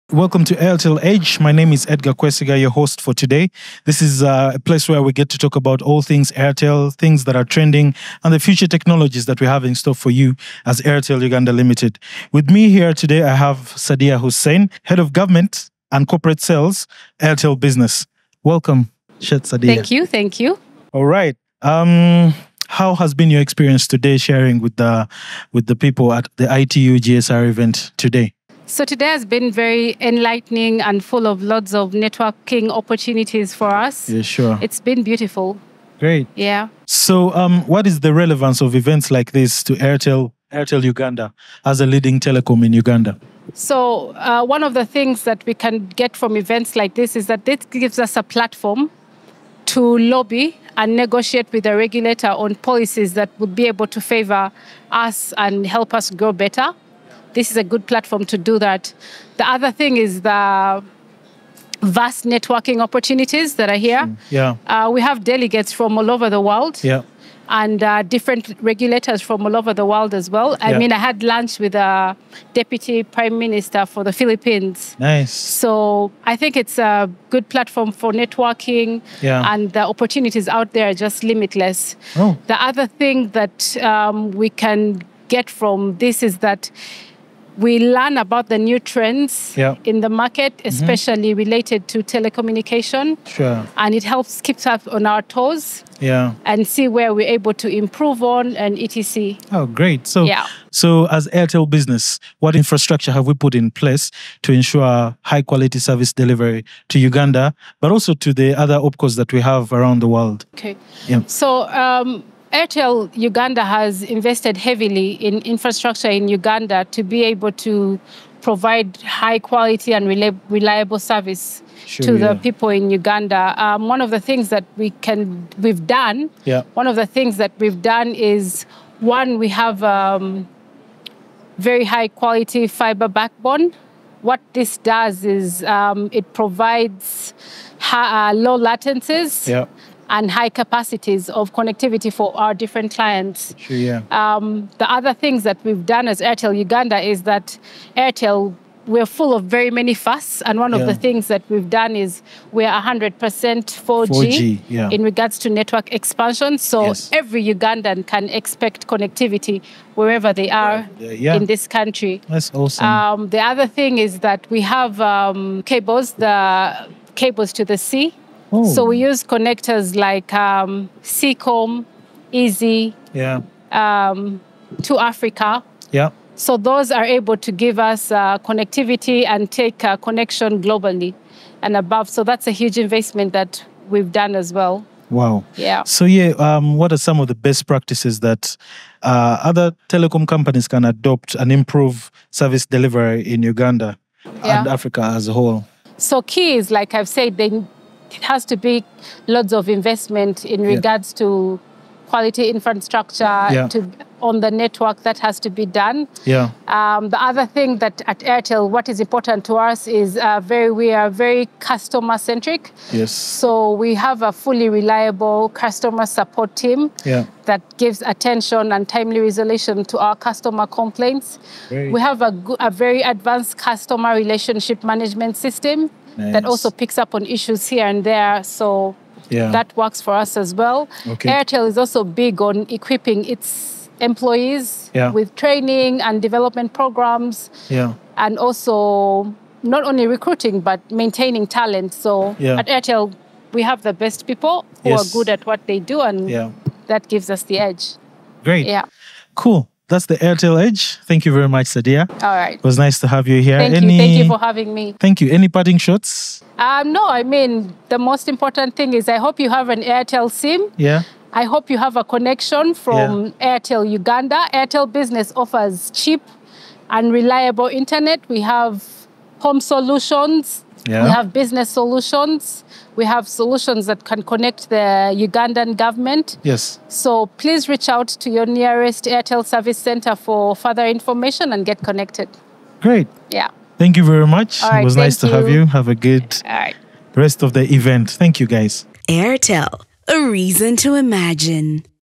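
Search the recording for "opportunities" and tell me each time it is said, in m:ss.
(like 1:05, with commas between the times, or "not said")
0:32, 1:02, 1:19.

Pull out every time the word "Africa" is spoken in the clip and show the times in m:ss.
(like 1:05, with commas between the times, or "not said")
2:54, 3:14.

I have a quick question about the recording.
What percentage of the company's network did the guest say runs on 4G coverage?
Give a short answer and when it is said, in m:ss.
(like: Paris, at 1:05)
100%, at 2:32.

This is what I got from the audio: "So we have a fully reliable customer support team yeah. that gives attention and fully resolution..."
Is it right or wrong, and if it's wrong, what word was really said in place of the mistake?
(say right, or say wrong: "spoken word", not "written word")
wrong: "timely", not "fully".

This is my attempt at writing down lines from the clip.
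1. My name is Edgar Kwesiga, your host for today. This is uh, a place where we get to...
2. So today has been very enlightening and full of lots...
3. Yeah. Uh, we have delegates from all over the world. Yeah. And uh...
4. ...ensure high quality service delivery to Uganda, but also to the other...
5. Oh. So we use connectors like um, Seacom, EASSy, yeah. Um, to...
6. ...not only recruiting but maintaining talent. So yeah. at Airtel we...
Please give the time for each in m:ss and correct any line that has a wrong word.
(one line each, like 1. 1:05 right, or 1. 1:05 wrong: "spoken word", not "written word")
1. 0:01 right
2. 0:28 right
3. 1:04 right
4. 1:44 right
5. 2:48 right
6. 3:59 right.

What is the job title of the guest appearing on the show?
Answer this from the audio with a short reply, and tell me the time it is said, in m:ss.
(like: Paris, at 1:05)
Head of Government and Corporate Sales, at 0:14.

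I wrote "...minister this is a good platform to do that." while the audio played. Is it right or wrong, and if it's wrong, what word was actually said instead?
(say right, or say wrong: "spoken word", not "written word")
wrong: "better", not "minister".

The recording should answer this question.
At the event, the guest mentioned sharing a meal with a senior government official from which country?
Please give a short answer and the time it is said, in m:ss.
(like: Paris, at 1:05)
Philippines, at 1:14.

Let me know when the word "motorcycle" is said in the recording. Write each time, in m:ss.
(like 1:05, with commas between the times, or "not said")
not said.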